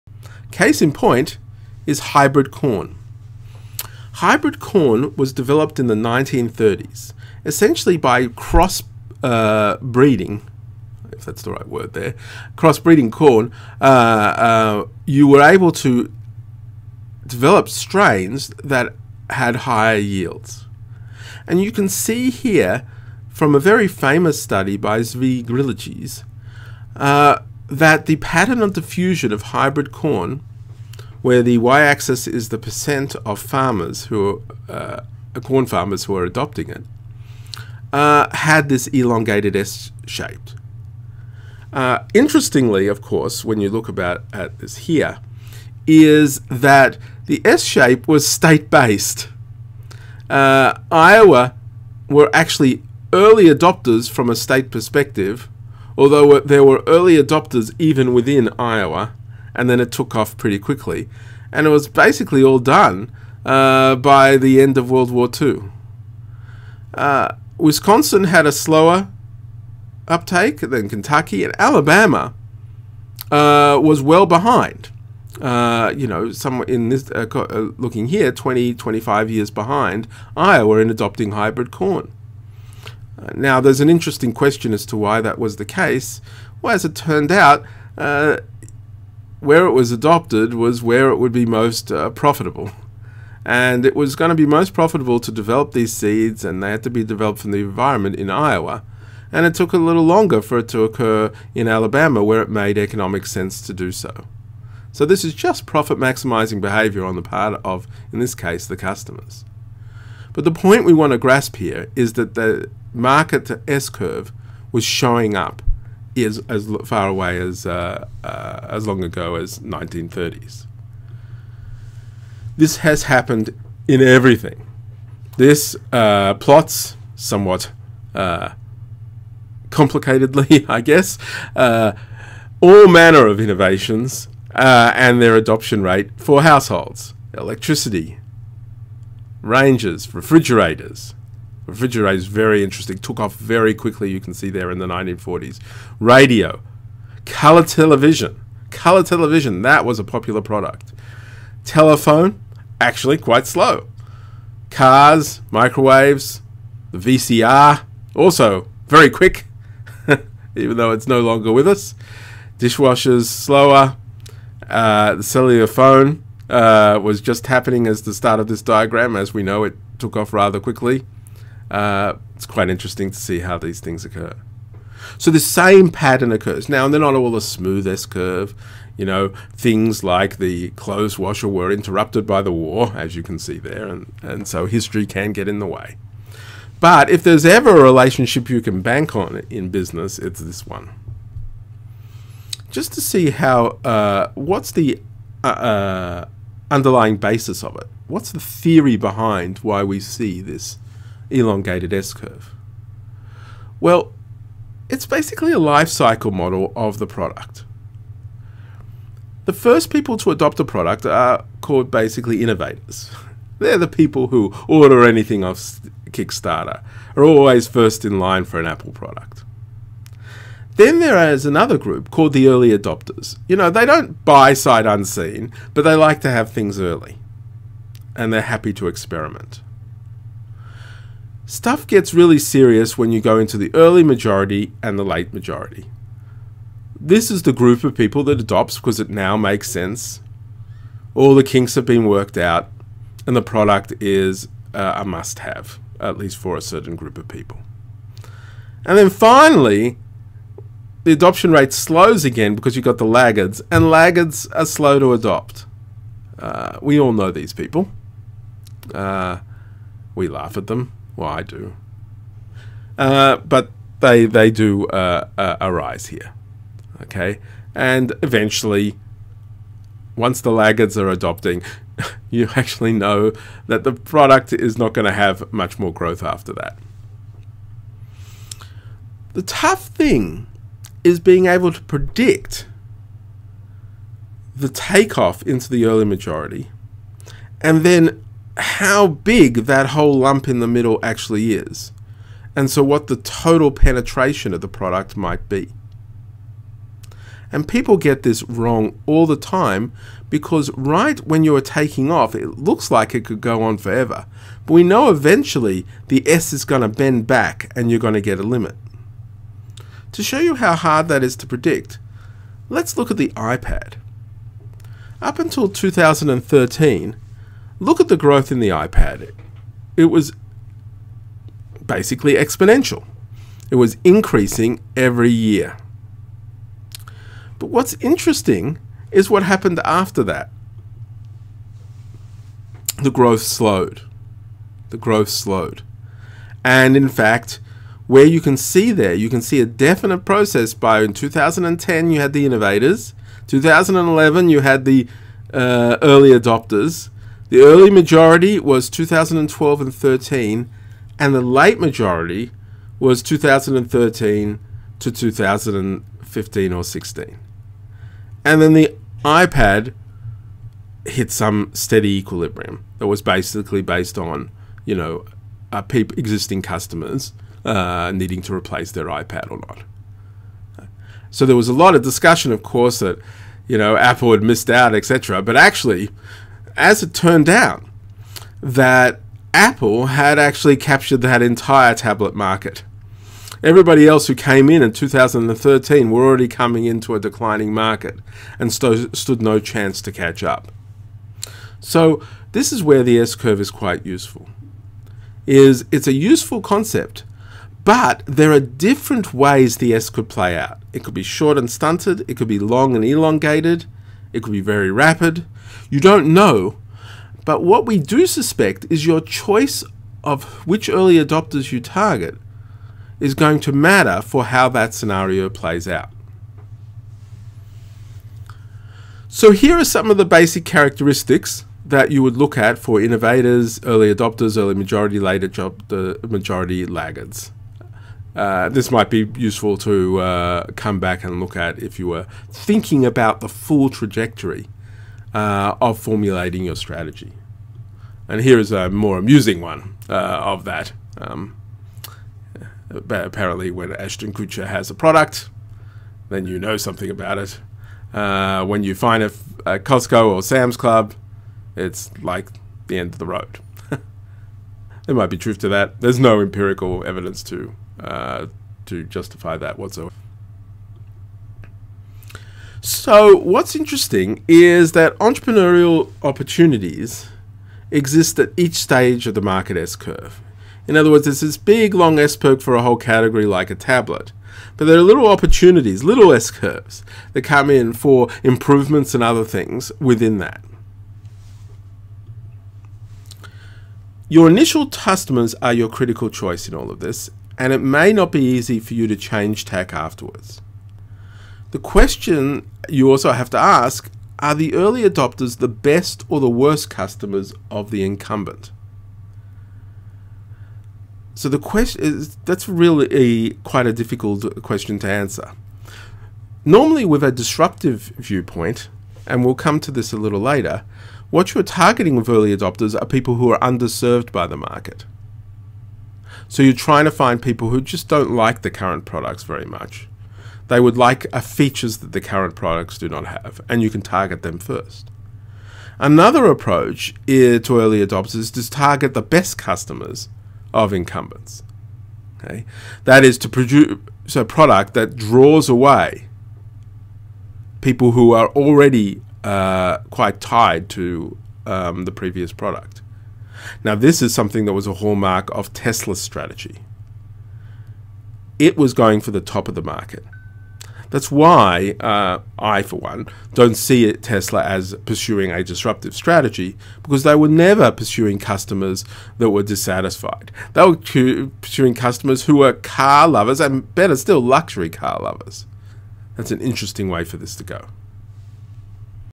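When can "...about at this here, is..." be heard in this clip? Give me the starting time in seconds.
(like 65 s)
43 s.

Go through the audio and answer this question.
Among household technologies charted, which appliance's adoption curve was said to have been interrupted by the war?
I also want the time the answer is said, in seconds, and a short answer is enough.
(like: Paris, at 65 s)
clothes washer, at 180 s.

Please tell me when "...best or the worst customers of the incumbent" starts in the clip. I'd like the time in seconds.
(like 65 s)
495 s.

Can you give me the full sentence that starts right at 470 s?
In other words, there's this big long S curve for a whole category like a tablet.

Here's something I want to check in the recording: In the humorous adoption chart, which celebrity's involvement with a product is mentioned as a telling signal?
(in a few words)
Ashton Kutcher.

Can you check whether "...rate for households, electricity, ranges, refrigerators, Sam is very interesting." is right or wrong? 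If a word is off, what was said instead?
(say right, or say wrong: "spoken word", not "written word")
wrong: "Refrigerator", not "Sam".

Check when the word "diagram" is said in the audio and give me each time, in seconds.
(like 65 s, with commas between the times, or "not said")
168 s.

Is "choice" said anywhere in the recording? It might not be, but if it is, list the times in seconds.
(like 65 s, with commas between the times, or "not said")
409 s, 486 s.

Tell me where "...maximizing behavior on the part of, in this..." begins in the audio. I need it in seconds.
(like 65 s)
105 s.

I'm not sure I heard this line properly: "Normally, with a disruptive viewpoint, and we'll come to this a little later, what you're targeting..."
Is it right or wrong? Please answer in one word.
right.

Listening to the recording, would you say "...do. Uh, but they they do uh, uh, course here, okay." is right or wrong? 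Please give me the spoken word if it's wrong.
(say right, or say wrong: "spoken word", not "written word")
wrong: "arise", not "course".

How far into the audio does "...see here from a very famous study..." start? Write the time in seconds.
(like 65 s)
21 s.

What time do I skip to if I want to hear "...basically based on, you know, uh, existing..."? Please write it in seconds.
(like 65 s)
363 s.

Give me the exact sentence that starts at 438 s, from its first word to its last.
And here is a more amusing one uh, of that.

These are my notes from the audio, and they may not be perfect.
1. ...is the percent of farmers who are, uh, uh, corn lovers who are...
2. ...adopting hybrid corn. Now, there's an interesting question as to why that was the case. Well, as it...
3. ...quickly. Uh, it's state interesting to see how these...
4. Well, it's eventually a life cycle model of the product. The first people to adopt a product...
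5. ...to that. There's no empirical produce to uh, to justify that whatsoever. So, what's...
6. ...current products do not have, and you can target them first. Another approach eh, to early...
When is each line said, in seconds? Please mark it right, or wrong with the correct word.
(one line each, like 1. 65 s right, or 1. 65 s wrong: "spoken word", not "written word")
1. 32 s wrong: "farmers", not "lovers"
2. 80 s right
3. 170 s wrong: "quite", not "state"
4. 203 s wrong: "basically", not "eventually"
5. 455 s wrong: "evidence", not "produce"
6. 522 s right.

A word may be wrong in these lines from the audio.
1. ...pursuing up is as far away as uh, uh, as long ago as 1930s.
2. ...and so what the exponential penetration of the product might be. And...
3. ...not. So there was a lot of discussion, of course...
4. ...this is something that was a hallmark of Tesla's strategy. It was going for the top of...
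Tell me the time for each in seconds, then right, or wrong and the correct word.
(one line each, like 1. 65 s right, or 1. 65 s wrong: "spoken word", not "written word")
1. 114 s wrong: "showing", not "pursuing"
2. 292 s wrong: "total", not "exponential"
3. 369 s right
4. 543 s right.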